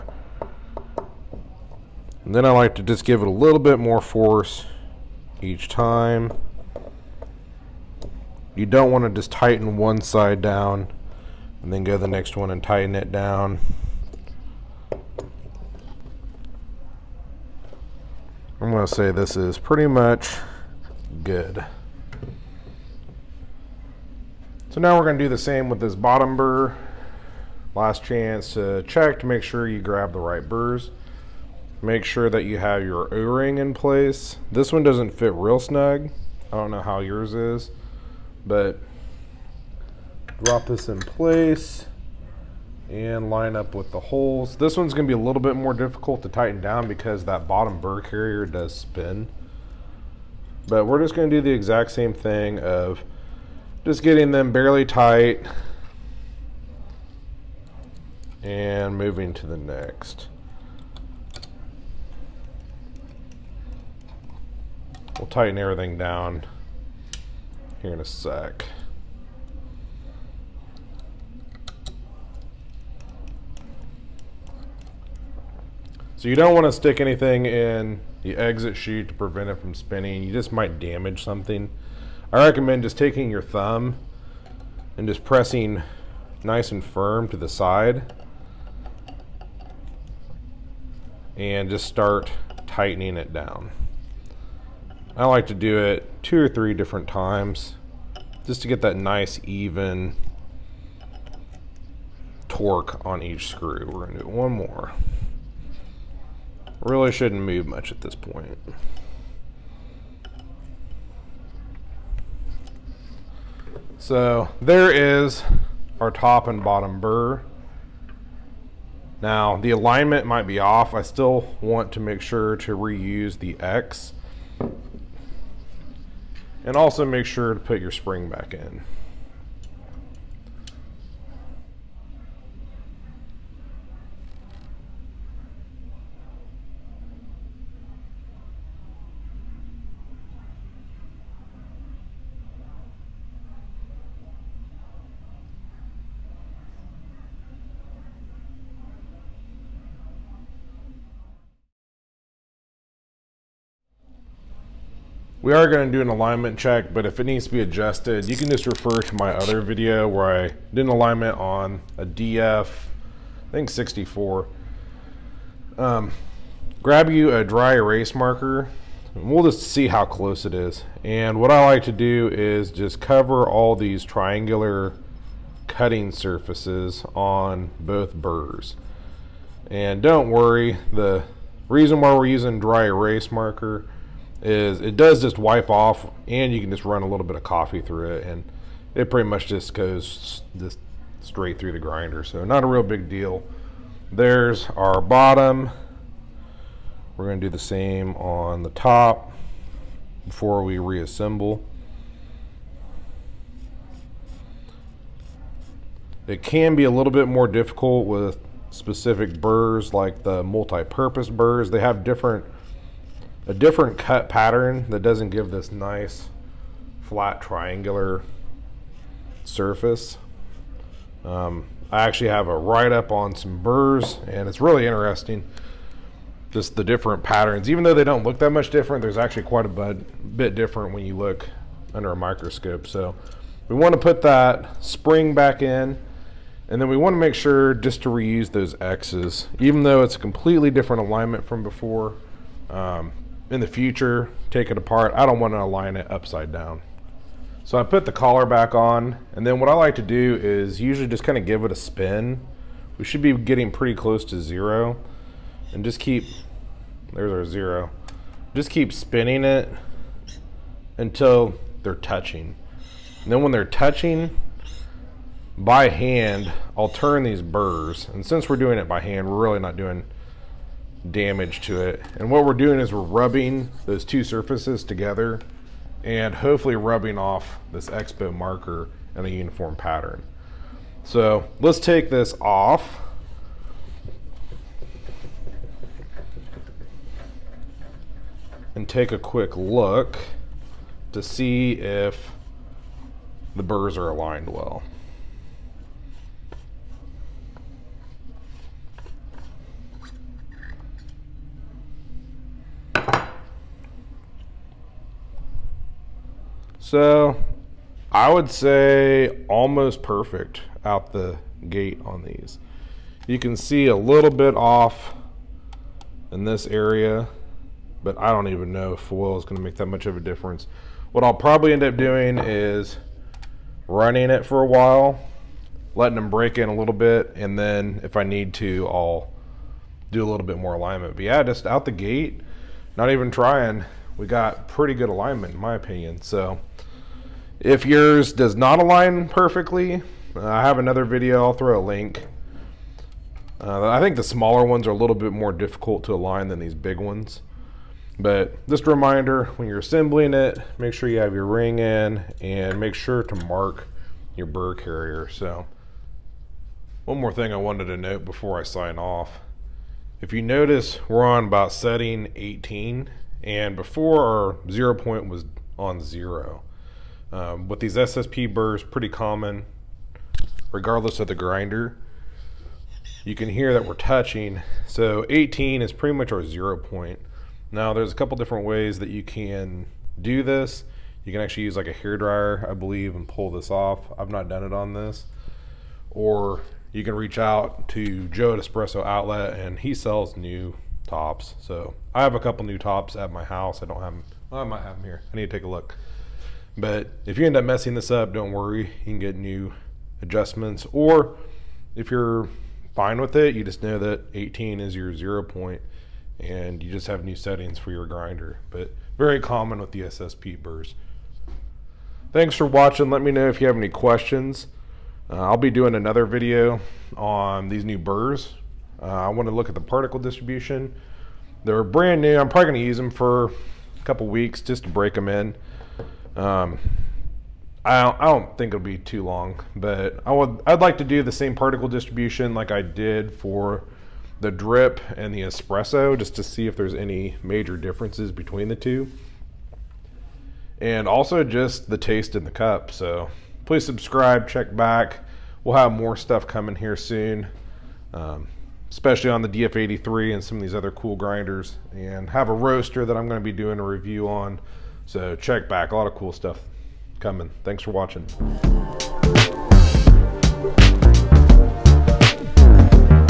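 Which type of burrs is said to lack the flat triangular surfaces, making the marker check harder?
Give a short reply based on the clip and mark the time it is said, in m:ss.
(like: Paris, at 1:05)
Multi-purpose burrs, at 3:30.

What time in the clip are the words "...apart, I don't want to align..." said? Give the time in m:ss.
4:04.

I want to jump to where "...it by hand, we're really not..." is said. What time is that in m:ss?
4:28.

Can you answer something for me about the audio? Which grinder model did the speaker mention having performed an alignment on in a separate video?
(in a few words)
DF 64.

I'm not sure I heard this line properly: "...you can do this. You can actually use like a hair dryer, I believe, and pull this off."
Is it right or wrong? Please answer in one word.
right.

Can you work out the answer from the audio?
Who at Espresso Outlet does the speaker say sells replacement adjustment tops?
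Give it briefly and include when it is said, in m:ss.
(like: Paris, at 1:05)
Joe, at 6:28.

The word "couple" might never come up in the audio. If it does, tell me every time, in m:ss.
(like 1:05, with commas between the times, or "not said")
6:18, 6:32, 7:04.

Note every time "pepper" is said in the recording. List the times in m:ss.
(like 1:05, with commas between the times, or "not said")
not said.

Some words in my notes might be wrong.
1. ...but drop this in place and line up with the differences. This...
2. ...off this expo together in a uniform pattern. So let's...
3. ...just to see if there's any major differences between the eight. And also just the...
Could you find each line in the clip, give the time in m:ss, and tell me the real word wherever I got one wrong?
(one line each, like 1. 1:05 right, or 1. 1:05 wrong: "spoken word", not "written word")
1. 0:38 wrong: "holes", not "differences"
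2. 4:37 wrong: "marker", not "together"
3. 7:16 wrong: "two", not "eight".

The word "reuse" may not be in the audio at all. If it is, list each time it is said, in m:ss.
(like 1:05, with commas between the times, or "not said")
2:02, 3:58.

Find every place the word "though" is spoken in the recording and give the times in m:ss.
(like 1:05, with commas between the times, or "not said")
3:47, 3:59.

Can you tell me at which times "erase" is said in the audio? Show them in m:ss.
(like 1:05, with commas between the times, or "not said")
2:47, 3:02.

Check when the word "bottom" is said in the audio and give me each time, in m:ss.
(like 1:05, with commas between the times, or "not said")
0:25, 0:47, 1:56, 3:15.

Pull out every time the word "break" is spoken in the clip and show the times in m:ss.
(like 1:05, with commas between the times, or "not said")
5:26, 7:04.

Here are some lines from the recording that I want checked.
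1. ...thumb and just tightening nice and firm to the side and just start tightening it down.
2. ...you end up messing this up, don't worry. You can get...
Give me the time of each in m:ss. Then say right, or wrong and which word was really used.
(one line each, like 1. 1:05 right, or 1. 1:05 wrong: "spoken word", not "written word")
1. 1:23 wrong: "pressing", not "tightening"
2. 6:37 right.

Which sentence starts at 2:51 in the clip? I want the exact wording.
And what I like to do is just cover all these triangular cutting surfaces on both burrs.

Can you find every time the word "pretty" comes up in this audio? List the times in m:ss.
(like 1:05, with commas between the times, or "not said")
0:19, 3:09, 4:13, 5:34, 6:08, 6:15.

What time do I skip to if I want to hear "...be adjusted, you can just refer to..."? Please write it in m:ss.
2:37.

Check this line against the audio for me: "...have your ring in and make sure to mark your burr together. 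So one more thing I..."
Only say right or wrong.
wrong.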